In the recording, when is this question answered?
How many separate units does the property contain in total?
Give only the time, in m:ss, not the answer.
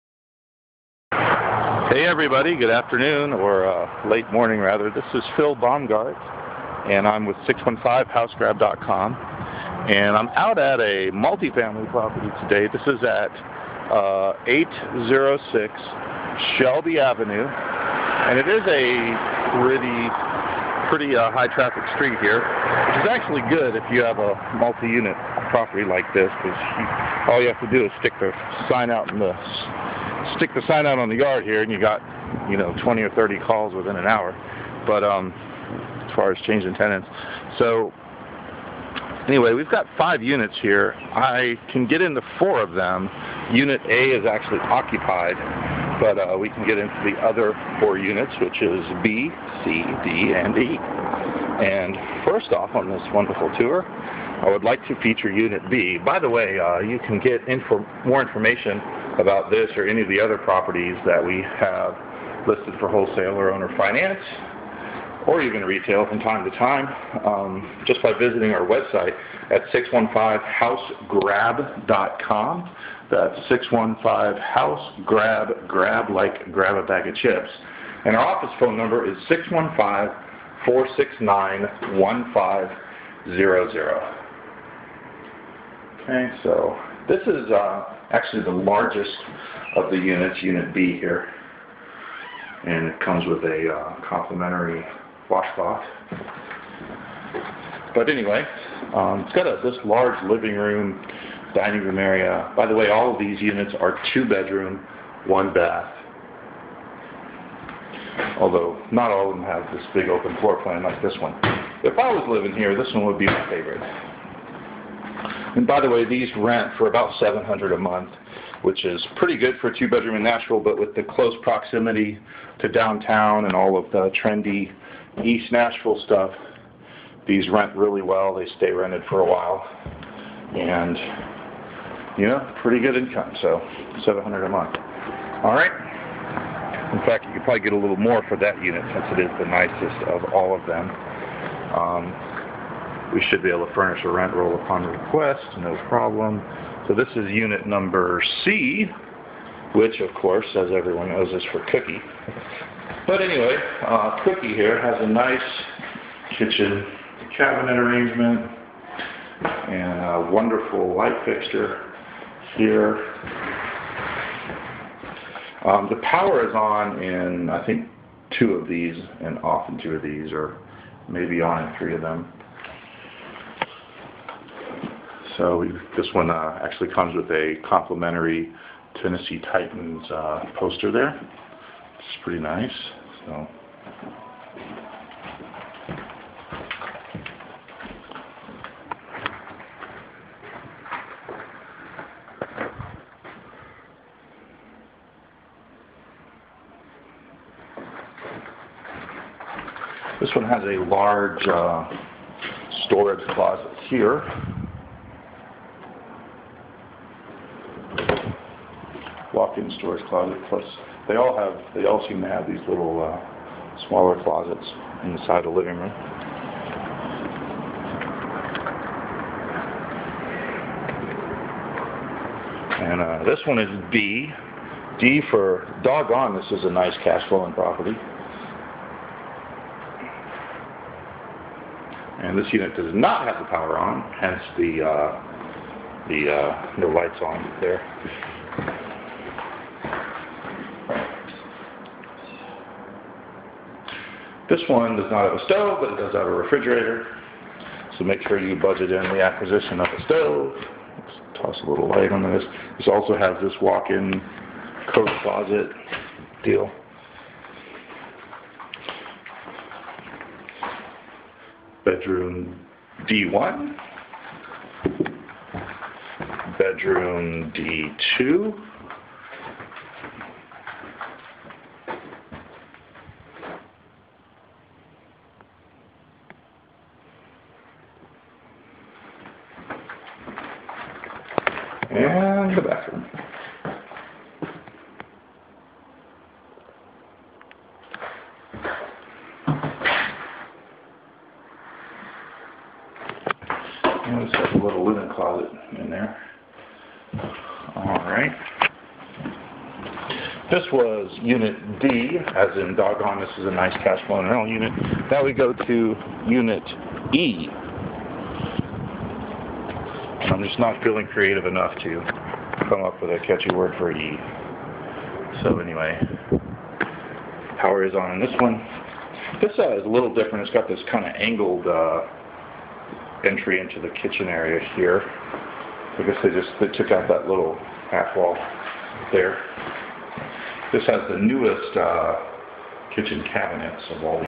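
0:39.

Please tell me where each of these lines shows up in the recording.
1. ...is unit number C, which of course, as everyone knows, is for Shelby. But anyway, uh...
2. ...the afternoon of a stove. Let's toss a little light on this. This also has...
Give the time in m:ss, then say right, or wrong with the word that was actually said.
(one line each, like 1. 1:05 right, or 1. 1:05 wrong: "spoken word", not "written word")
1. 2:27 wrong: "Cookie", not "Shelby"
2. 4:09 wrong: "acquisition", not "afternoon".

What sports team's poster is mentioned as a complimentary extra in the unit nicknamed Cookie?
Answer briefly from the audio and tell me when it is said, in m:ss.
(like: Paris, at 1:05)
Tennessee Titans, at 2:59.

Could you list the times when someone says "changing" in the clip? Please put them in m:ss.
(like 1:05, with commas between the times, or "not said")
0:36.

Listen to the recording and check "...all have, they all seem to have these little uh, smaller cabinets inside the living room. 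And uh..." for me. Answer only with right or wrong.
wrong.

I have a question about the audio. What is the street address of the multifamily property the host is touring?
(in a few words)
806 Shelby Avenue.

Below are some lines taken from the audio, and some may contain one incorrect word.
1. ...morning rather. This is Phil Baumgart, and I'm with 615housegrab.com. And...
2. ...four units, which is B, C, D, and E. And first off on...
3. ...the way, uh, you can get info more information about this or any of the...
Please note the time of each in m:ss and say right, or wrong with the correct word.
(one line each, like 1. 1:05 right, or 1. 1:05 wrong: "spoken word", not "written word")
1. 0:04 right
2. 0:47 right
3. 0:56 right.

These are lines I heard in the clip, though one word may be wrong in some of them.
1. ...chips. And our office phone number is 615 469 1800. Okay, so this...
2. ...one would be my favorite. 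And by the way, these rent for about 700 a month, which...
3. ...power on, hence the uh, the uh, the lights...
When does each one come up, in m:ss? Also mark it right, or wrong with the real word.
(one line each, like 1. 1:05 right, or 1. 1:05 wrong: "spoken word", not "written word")
1. 1:17 wrong: "1500", not "1800"
2. 1:52 right
3. 3:53 right.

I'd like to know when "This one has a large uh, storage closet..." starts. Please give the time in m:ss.
3:20.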